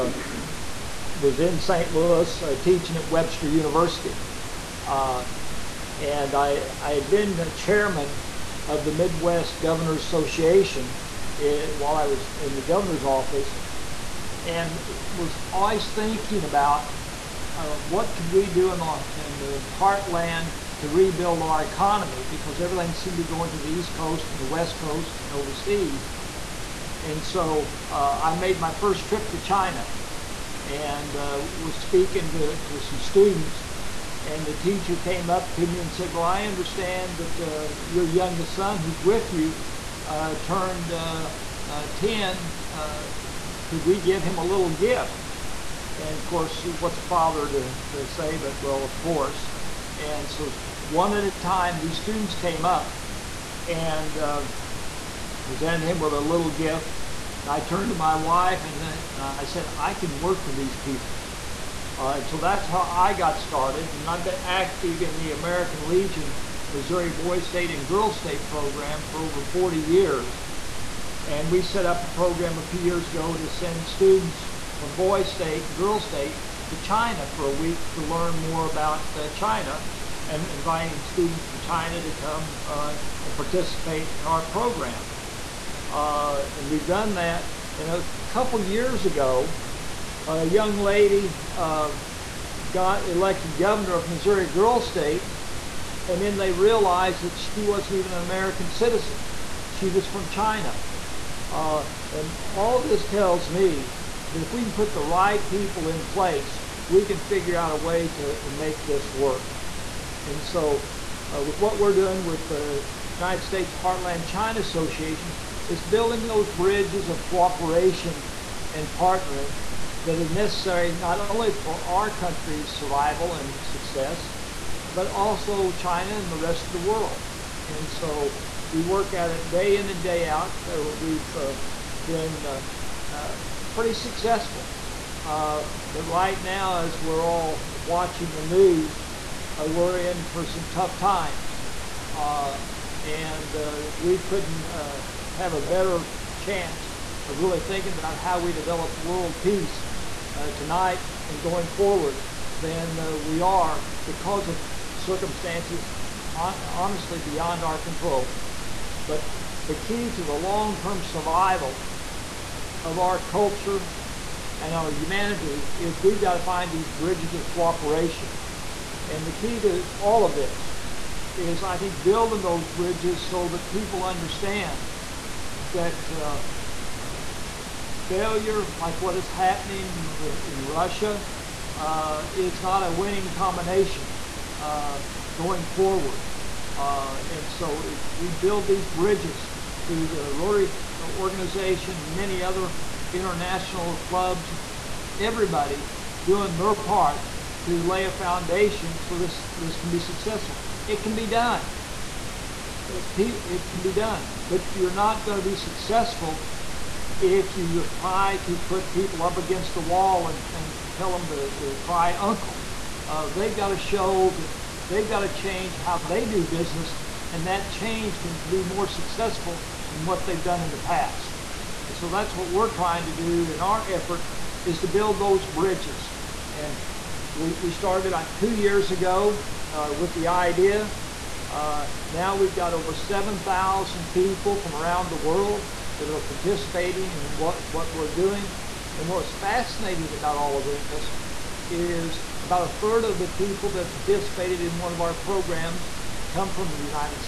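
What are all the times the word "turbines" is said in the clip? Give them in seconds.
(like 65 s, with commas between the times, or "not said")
not said.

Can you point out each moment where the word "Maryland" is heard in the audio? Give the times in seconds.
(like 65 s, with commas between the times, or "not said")
not said.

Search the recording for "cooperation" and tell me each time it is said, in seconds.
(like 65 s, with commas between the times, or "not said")
117 s, 167 s.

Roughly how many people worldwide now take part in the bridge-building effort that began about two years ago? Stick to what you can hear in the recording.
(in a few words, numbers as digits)
over 7,000.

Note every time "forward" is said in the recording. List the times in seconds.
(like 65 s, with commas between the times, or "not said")
151 s, 185 s.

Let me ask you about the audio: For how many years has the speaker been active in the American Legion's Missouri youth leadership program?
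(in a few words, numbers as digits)
over 40 years.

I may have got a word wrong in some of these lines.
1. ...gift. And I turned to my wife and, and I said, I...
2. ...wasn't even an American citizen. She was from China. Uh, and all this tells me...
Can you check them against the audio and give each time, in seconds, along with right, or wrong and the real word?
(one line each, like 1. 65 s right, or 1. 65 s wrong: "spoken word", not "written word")
1. 56 s right
2. 97 s right.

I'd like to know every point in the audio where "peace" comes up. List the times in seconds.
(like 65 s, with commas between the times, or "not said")
149 s.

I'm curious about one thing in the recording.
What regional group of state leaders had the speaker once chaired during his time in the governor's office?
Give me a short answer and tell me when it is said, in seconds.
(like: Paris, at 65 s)
Midwest Governors Association, at 8 s.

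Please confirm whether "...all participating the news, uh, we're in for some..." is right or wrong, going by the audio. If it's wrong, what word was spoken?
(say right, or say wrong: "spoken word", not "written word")
wrong: "watching", not "participating".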